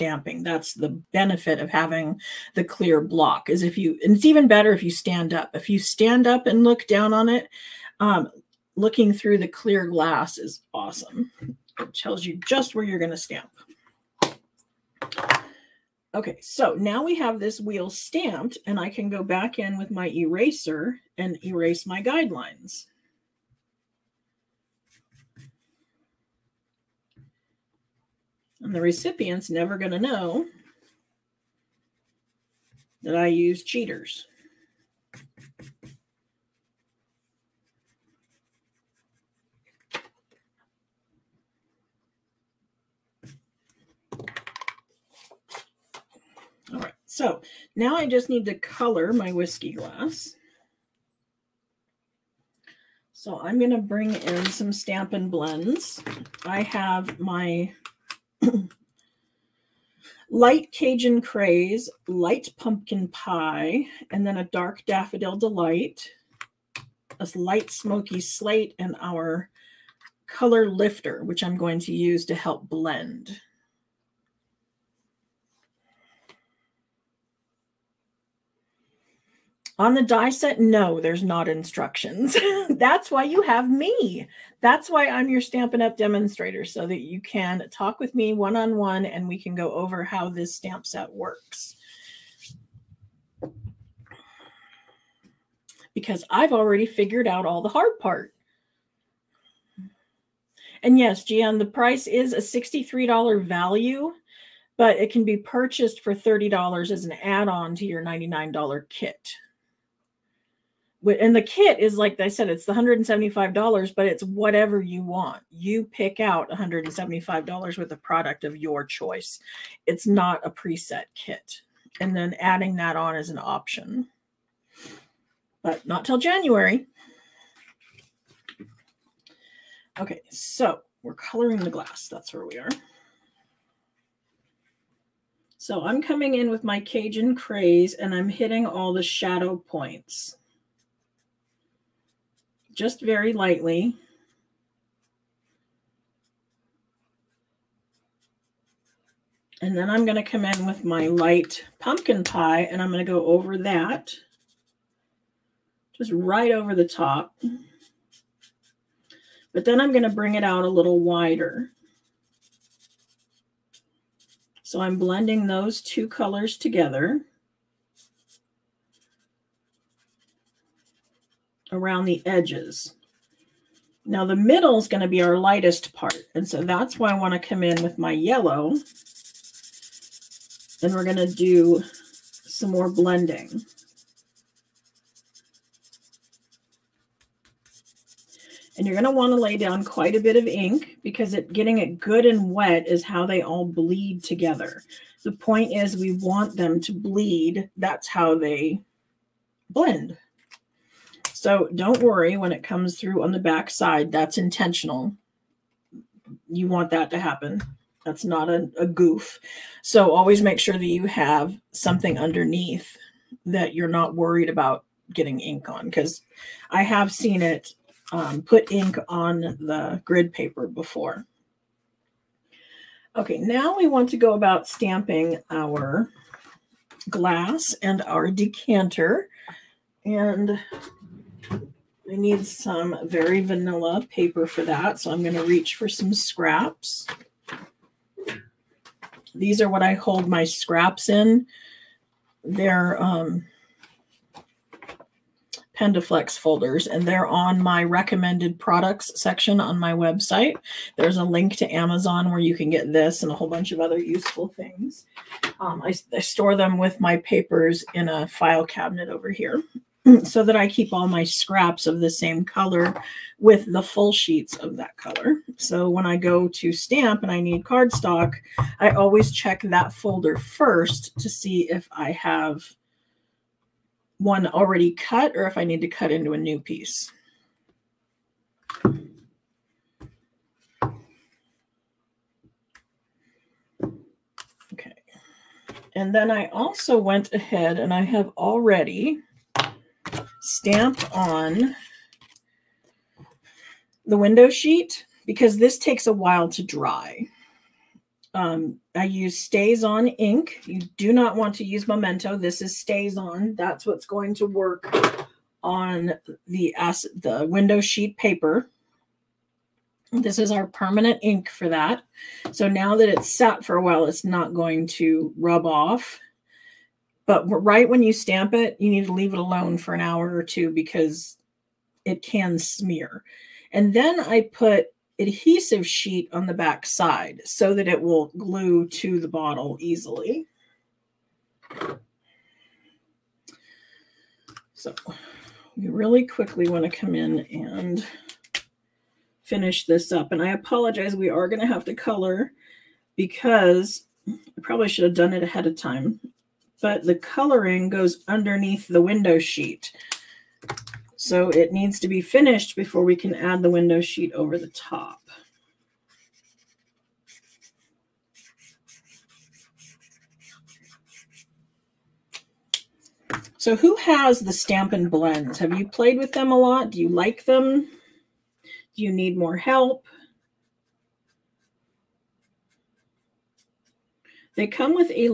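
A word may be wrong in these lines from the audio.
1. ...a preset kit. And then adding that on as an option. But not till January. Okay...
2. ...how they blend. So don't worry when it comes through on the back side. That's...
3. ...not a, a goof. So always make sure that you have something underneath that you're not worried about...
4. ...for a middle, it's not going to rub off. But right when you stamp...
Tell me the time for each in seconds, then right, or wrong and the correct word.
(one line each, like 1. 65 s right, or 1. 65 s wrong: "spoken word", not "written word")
1. 120 s right
2. 198 s right
3. 208 s right
4. 313 s wrong: "while", not "middle".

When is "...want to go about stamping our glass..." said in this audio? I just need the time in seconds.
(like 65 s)
223 s.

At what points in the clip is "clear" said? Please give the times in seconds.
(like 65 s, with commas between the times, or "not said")
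2 s, 9 s.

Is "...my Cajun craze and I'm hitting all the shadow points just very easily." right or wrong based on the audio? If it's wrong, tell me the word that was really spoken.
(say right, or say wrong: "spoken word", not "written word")
wrong: "lightly", not "easily".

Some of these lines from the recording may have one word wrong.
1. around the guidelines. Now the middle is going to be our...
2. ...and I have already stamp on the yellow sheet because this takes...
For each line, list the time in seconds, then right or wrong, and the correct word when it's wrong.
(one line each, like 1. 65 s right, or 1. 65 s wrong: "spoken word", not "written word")
1. 171 s wrong: "edges", not "guidelines"
2. 287 s wrong: "window", not "yellow".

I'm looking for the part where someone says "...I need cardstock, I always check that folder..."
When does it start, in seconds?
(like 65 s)
267 s.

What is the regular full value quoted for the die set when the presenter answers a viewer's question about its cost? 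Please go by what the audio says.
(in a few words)
$63.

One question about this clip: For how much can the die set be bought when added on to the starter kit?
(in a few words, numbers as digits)
$30.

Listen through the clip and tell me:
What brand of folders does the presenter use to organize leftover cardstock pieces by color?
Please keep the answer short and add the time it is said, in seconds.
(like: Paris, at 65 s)
Pendaflex, at 245 s.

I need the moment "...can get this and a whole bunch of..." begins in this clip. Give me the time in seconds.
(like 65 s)
252 s.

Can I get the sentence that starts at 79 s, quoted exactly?
On the die set, no, there's not instructions.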